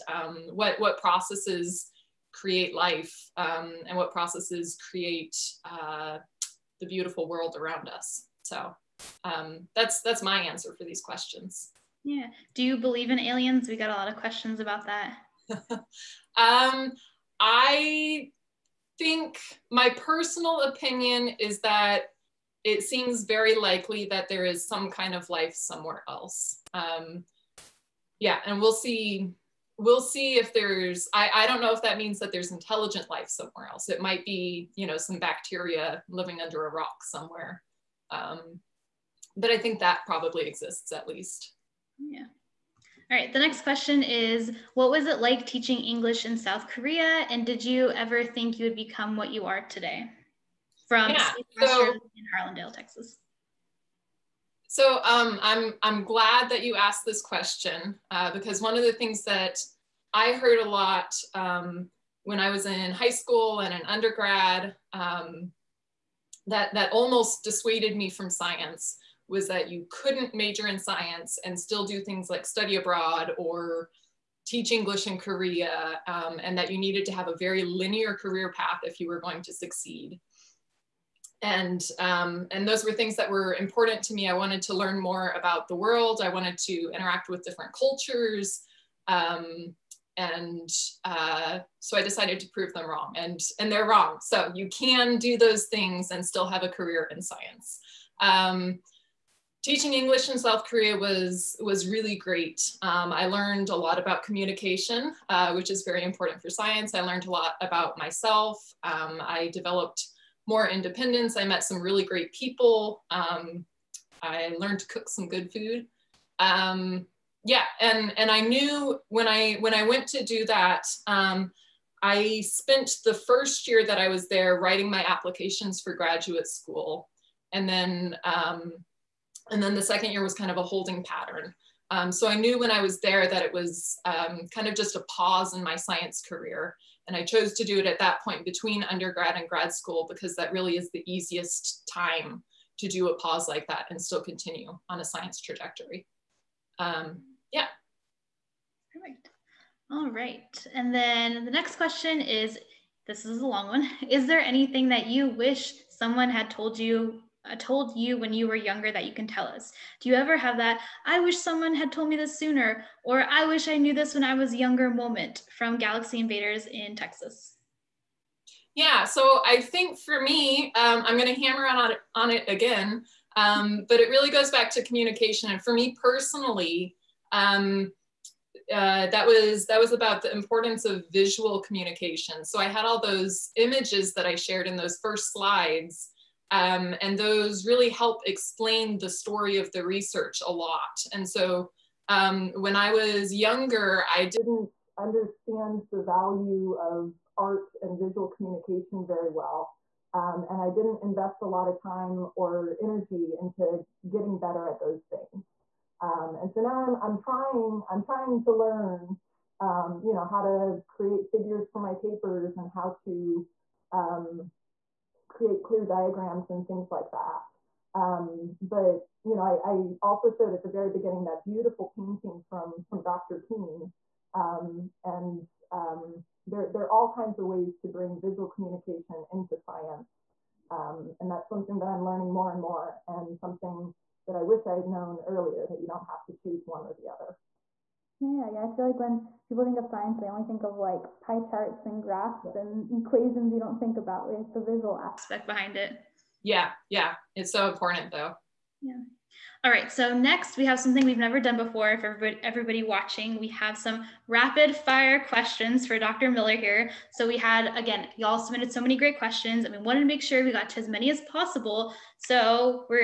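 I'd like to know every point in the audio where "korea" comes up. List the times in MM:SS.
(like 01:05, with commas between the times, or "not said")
00:46, 01:15, 01:40.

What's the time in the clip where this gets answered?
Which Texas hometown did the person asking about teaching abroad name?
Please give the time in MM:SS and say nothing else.
00:52.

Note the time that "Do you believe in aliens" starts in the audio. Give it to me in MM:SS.
00:12.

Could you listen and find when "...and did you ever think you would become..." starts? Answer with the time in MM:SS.
00:47.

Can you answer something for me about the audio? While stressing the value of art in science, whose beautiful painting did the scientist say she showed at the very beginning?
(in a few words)
Dr. Keen.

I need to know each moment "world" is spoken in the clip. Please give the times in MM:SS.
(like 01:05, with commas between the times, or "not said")
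00:07, 01:25.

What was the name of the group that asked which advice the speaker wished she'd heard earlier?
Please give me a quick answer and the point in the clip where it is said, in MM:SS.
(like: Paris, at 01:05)
Galaxy Invaders, at 02:45.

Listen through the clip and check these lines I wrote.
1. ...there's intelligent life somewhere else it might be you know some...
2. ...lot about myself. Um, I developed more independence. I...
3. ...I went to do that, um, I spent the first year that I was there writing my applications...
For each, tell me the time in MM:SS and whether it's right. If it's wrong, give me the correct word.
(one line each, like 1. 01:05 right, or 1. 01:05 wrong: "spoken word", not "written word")
1. 00:32 right
2. 01:47 right
3. 01:59 right.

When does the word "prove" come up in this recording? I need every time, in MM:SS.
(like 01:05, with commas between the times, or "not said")
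01:32.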